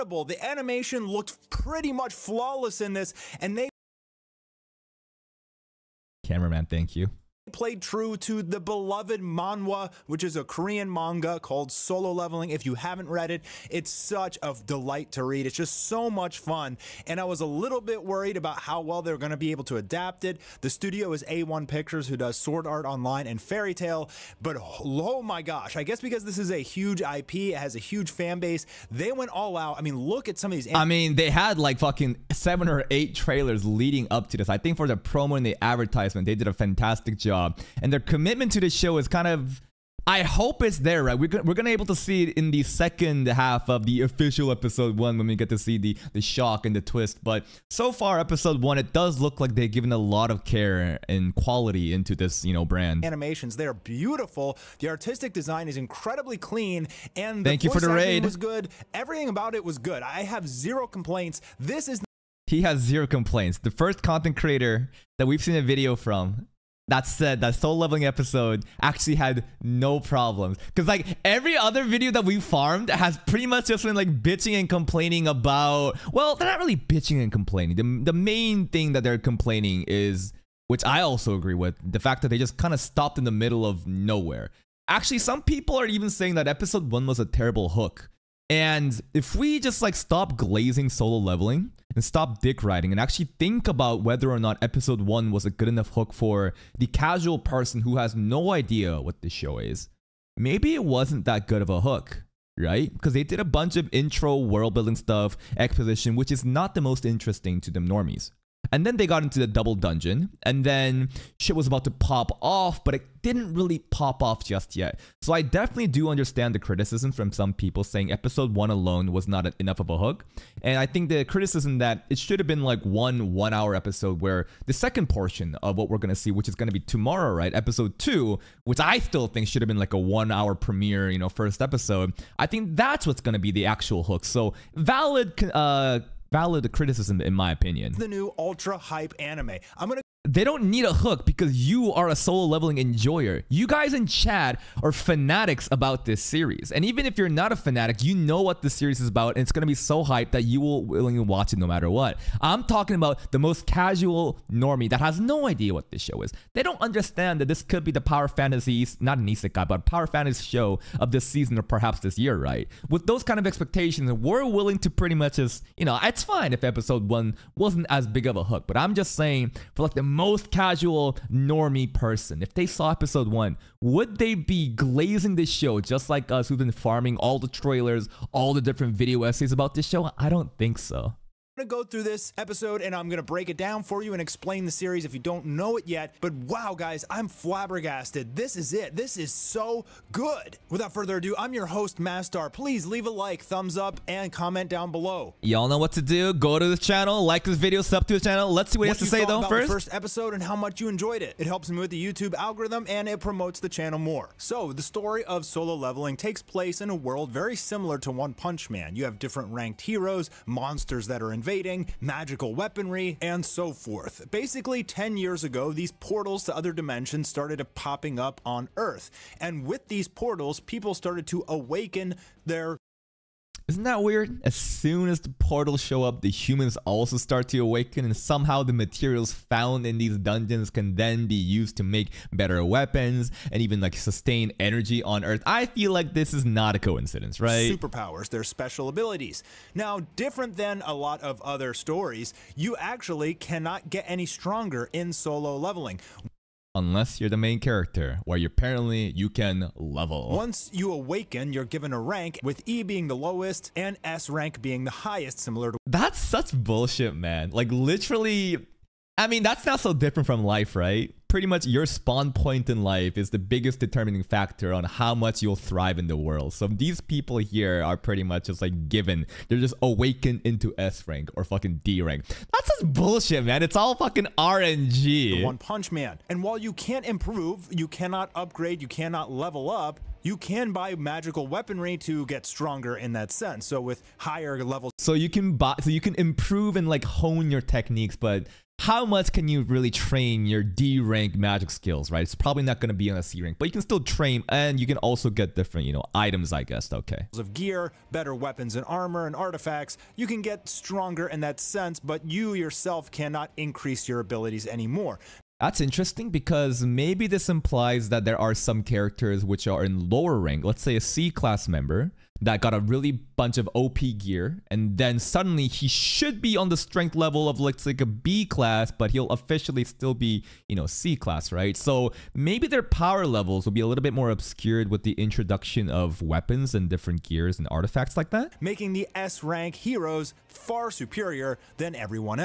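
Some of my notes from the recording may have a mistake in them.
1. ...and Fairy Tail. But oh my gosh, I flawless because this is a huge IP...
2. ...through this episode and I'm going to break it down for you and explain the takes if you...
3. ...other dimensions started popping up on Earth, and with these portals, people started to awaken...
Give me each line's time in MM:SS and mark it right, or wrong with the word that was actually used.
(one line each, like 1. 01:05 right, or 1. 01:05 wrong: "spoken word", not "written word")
1. 00:23 wrong: "guess", not "flawless"
2. 03:01 wrong: "series", not "takes"
3. 03:36 right.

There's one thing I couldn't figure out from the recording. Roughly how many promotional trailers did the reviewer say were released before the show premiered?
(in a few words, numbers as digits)
seven or eight.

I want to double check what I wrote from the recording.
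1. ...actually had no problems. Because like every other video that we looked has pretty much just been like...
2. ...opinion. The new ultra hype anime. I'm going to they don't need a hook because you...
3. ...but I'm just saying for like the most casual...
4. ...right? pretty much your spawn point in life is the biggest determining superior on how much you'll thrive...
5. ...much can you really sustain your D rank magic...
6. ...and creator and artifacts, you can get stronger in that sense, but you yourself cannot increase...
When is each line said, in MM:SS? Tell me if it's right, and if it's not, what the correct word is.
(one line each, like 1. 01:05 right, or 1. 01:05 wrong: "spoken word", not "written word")
1. 01:08 wrong: "farmed", not "looked"
2. 02:17 right
3. 02:48 right
4. 04:20 wrong: "factor", not "superior"
5. 04:49 wrong: "train", not "sustain"
6. 04:58 wrong: "armor", not "creator".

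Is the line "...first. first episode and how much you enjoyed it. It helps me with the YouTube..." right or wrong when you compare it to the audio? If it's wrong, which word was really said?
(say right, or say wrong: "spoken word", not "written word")
right.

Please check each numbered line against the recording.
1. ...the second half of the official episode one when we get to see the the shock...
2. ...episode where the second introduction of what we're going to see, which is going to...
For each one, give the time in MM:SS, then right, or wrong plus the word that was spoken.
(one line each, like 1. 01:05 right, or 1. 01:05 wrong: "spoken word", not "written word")
1. 00:42 right
2. 02:03 wrong: "portion", not "introduction".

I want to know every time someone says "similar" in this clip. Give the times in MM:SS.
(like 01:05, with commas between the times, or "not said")
03:27, 04:15.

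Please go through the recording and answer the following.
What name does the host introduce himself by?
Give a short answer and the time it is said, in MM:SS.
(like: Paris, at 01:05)
Mastar, at 03:11.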